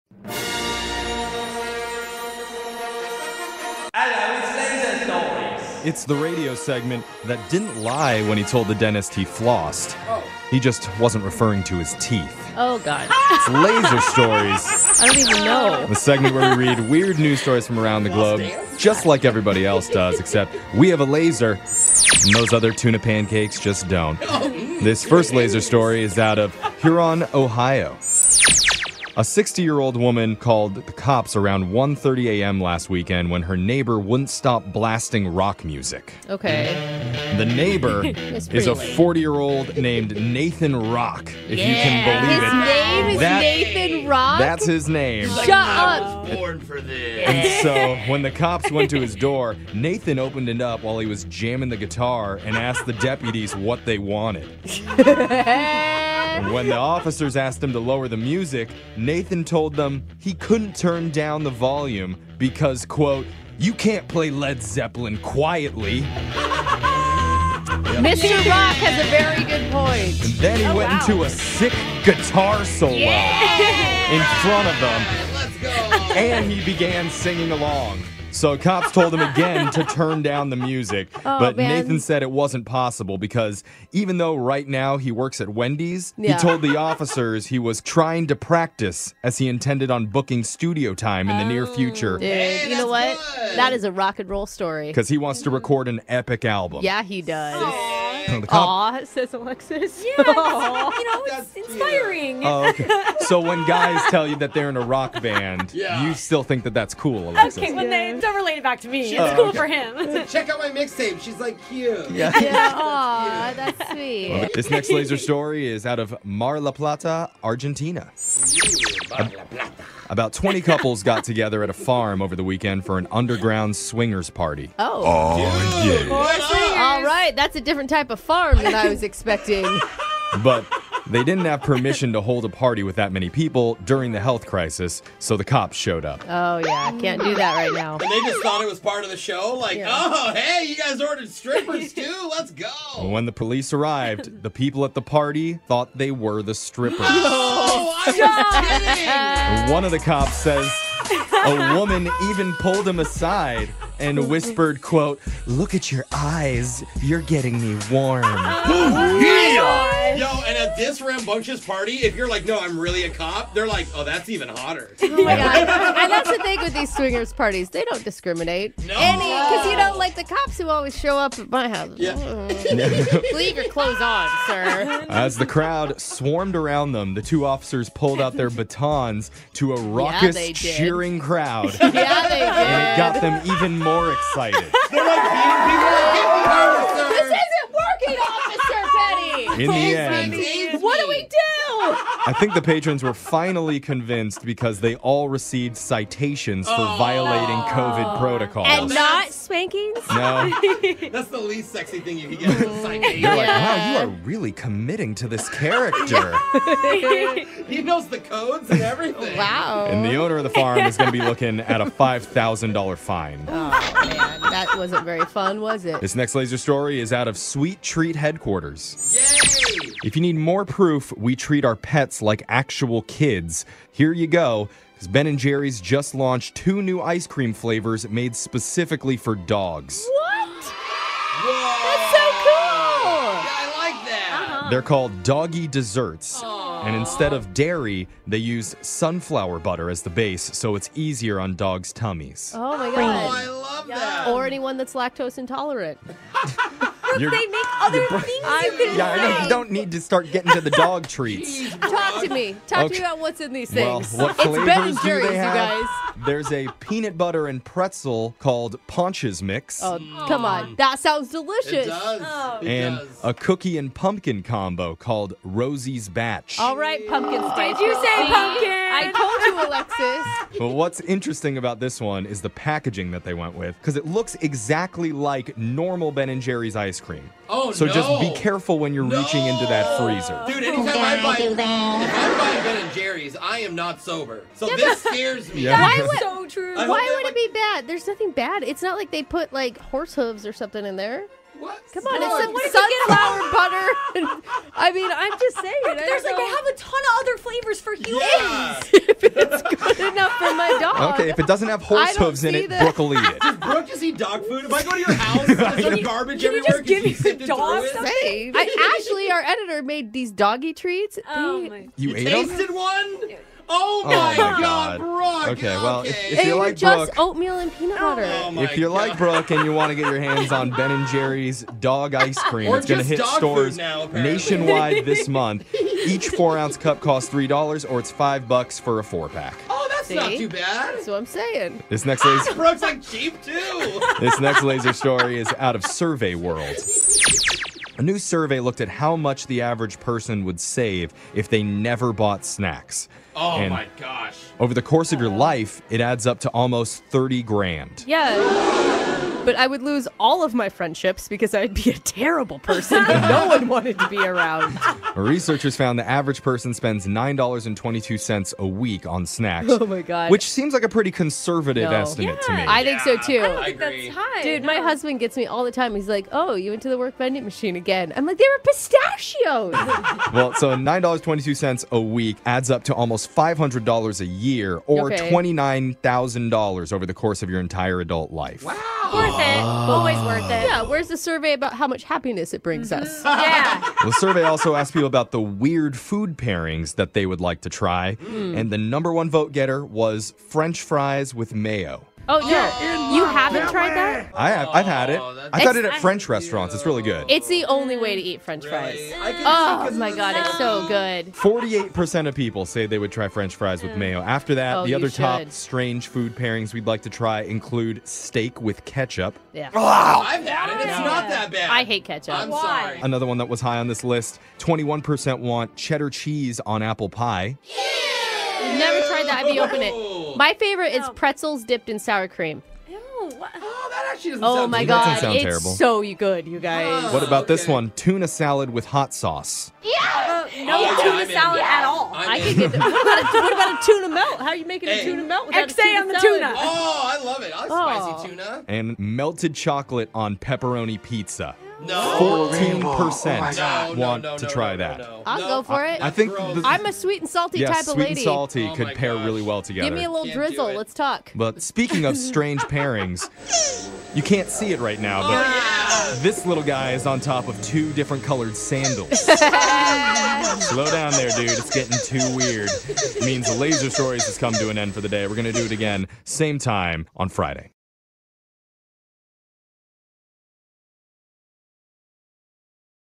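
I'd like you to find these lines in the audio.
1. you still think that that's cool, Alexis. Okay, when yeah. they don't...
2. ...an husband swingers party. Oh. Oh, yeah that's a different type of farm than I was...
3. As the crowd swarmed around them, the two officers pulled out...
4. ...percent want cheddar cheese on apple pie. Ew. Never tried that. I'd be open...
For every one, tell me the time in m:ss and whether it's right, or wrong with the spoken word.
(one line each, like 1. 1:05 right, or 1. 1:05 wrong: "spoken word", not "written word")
1. 1:46 right
2. 2:02 wrong: "underground", not "husband"
3. 2:55 right
4. 6:55 right.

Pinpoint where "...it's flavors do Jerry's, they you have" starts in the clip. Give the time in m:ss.
4:14.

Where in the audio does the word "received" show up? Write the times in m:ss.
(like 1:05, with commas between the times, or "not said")
3:15.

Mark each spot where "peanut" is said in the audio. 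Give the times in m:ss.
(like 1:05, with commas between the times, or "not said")
4:16, 5:17.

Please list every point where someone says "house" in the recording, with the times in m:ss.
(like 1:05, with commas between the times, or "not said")
2:51, 5:05.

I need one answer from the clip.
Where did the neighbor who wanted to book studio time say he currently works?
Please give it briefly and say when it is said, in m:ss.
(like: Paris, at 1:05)
Wendy's, at 1:25.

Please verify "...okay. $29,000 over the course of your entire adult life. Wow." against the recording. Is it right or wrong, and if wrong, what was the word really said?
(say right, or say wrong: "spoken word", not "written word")
right.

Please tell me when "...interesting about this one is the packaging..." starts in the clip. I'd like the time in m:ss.
4:31.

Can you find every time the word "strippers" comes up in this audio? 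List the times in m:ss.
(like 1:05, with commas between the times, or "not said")
2:21, 2:26.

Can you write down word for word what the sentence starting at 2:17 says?
And they just thought it was part of the show.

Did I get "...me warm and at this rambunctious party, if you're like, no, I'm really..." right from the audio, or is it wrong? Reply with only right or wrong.
right.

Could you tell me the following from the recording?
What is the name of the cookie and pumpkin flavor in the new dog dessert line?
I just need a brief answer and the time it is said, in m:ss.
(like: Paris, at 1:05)
Rosie's Batch, at 4:25.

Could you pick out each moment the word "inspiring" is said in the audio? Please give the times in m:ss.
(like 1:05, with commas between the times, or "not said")
1:41.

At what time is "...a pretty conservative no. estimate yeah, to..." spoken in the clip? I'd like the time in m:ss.
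6:00.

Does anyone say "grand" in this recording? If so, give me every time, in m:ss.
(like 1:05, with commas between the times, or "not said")
5:47.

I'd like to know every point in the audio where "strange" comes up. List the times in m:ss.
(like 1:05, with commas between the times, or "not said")
6:45, 7:32.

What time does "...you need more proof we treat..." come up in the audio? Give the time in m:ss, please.
3:40.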